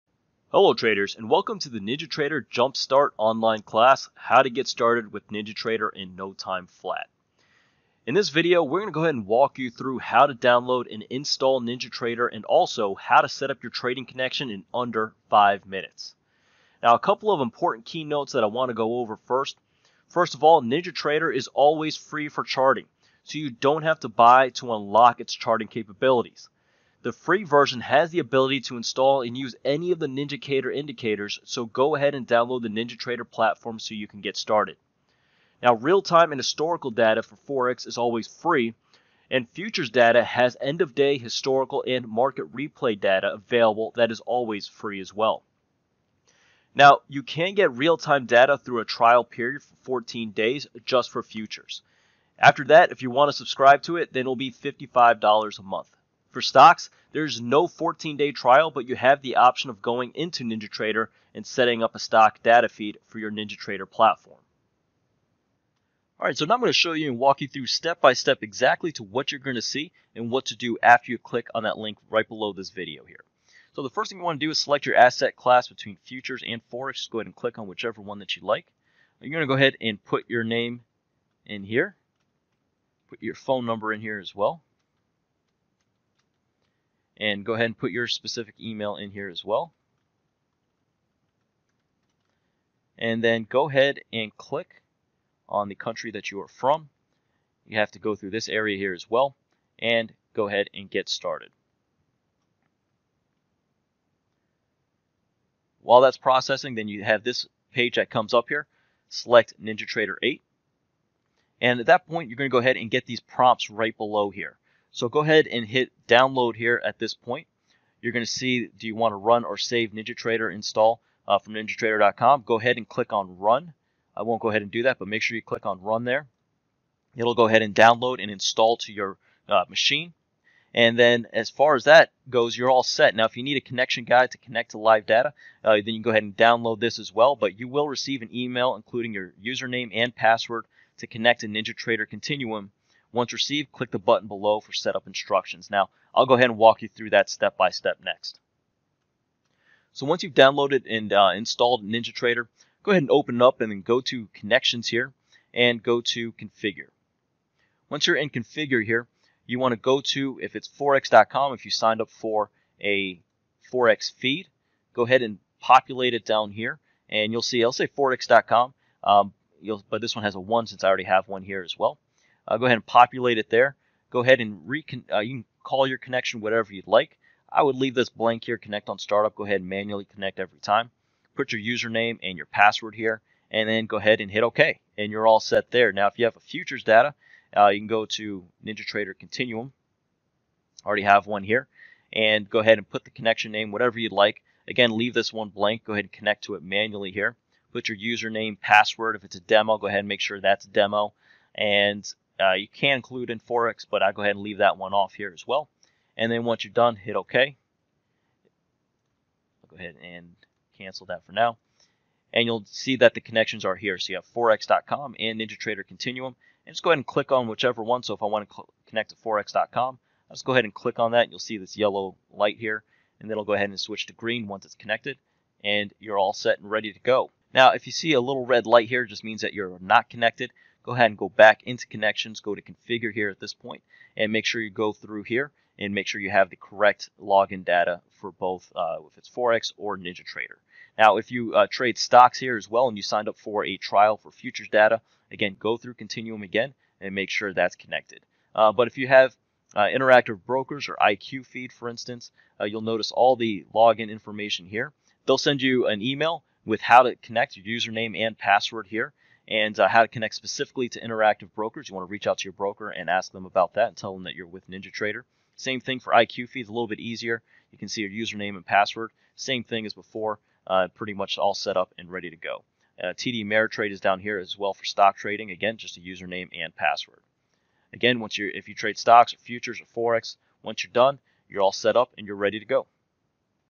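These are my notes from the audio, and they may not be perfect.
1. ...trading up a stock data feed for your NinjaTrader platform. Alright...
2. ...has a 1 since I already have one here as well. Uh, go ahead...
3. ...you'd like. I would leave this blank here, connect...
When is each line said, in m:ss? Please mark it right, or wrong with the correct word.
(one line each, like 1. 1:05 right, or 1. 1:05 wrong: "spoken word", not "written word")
1. 1:01 wrong: "setting", not "trading"
2. 2:50 right
3. 2:56 right.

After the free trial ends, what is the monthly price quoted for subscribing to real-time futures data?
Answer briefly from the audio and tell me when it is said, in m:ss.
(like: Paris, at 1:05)
$55, at 0:54.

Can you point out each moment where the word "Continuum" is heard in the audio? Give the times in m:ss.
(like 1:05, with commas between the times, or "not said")
2:22, 3:09, 3:35, 4:05.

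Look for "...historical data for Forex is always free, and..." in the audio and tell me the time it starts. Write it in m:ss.
0:36.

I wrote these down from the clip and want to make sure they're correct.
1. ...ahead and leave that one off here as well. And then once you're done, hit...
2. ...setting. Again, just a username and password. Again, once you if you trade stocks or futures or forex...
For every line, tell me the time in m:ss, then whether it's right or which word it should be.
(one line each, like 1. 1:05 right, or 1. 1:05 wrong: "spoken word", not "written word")
1. 3:24 right
2. 4:35 wrong: "trading", not "setting".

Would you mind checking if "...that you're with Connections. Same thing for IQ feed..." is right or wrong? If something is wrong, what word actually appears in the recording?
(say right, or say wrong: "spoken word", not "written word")
wrong: "NinjaTrader", not "Connections".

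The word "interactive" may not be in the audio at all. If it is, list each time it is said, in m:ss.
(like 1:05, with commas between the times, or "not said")
4:09, 4:21.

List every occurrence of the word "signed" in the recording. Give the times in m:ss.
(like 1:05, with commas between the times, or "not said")
2:41, 4:03.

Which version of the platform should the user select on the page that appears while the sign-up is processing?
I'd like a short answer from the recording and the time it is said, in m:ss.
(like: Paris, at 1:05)
NinjaTrader 8, at 1:49.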